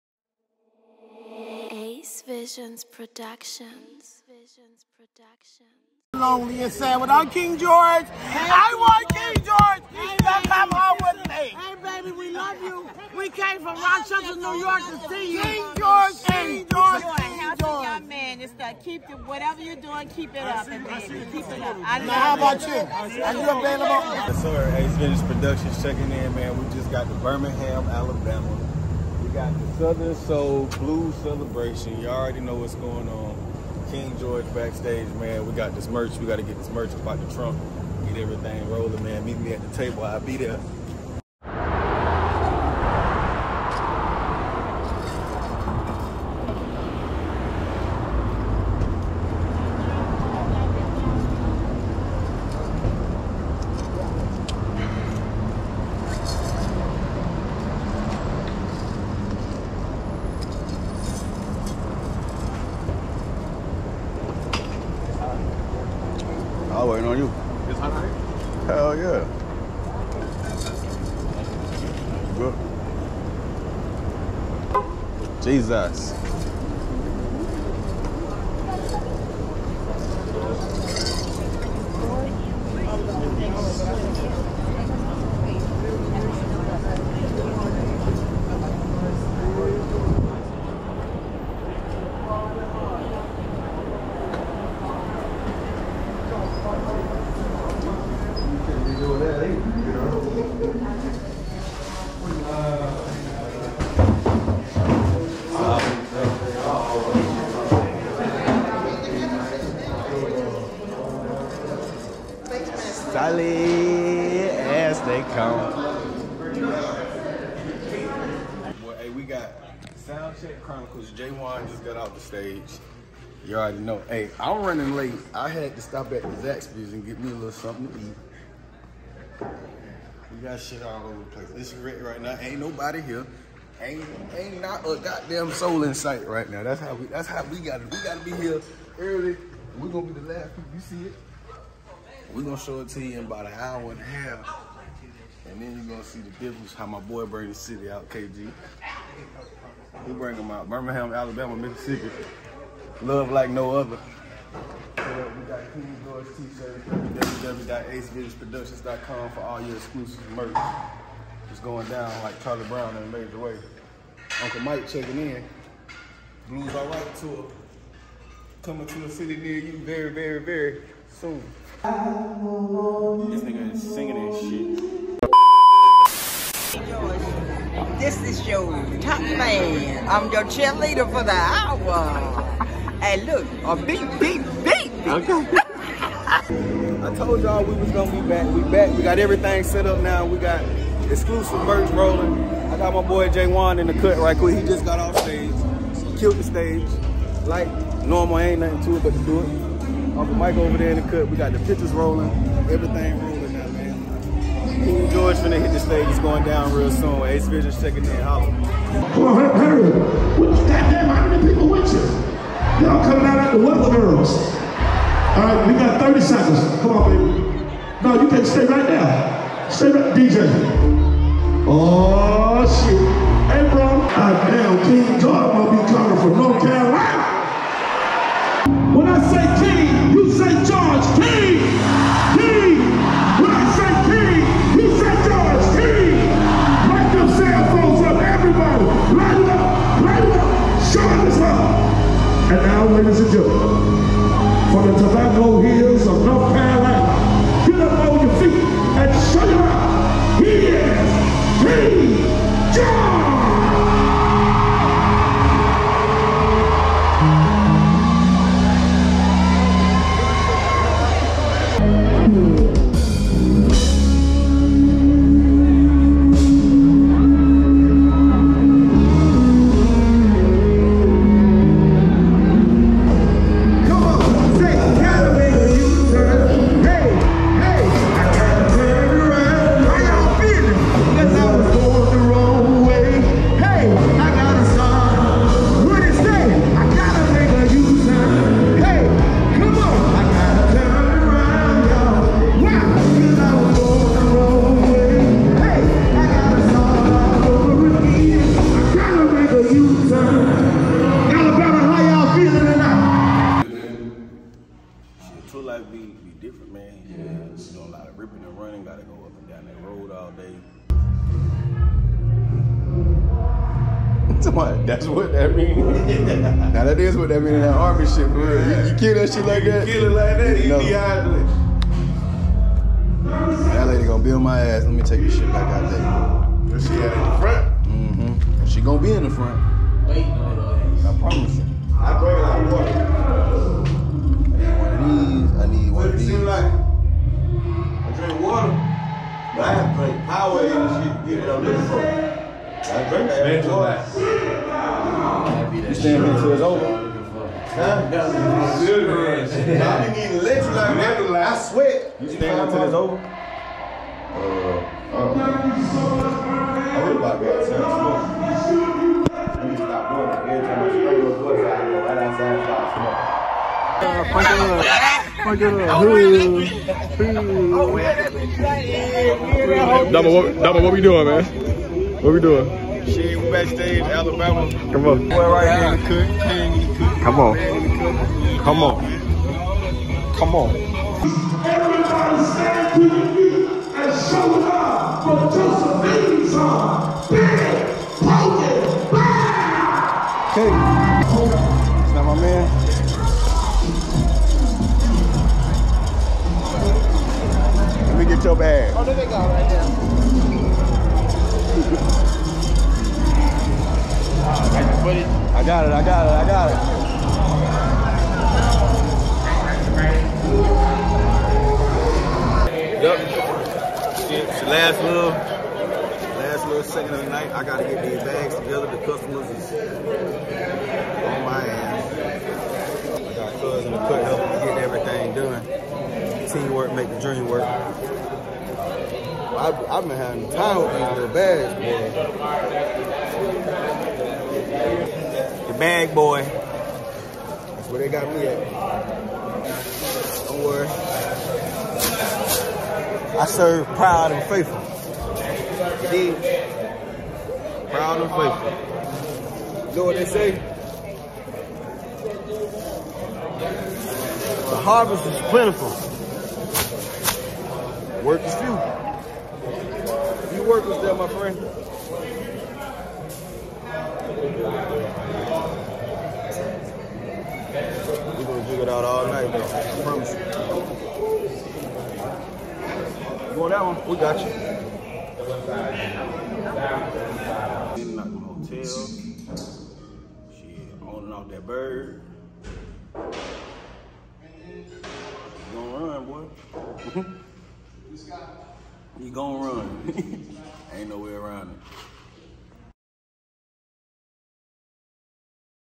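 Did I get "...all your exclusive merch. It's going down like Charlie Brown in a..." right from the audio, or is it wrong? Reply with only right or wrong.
right.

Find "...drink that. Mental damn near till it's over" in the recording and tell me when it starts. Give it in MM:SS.
05:43.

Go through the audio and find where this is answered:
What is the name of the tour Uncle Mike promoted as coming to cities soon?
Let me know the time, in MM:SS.
02:46.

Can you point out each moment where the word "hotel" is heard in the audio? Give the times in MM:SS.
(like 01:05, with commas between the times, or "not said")
07:58.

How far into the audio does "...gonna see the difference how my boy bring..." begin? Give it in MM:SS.
02:25.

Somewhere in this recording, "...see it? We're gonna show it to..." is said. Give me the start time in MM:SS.
02:20.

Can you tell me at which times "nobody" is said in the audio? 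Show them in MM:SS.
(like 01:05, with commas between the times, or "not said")
02:12.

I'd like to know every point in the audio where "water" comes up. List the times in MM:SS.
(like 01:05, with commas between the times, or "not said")
05:32, 05:38.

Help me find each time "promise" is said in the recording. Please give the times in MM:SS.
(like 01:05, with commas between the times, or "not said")
05:31, 07:50.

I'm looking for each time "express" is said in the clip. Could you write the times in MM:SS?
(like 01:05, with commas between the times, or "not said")
not said.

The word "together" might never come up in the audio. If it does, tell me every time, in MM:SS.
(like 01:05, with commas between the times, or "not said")
06:58.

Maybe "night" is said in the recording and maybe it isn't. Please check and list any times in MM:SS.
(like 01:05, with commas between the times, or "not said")
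06:57, 07:49.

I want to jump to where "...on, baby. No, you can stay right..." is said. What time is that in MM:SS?
03:36.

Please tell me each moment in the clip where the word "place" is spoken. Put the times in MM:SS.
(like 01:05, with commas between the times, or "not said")
02:11.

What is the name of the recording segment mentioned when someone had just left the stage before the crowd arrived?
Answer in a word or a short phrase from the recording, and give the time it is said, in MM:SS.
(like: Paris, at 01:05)
Soundcheck Chronicles, at 02:00.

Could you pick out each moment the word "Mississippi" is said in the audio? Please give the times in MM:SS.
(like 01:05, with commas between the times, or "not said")
02:31.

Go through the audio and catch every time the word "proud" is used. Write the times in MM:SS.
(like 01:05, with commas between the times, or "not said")
07:23, 07:27.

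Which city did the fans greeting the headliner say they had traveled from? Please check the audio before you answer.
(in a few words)
Rochester, New York.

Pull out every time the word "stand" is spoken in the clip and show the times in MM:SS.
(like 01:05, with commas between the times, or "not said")
06:22.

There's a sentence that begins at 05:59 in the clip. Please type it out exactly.
Every time I spray those books, I go right outside and stop smoking.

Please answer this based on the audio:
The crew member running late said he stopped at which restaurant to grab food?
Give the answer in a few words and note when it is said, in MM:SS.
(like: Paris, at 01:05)
Zaxby's, at 02:06.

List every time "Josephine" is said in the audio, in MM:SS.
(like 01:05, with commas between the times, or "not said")
06:25.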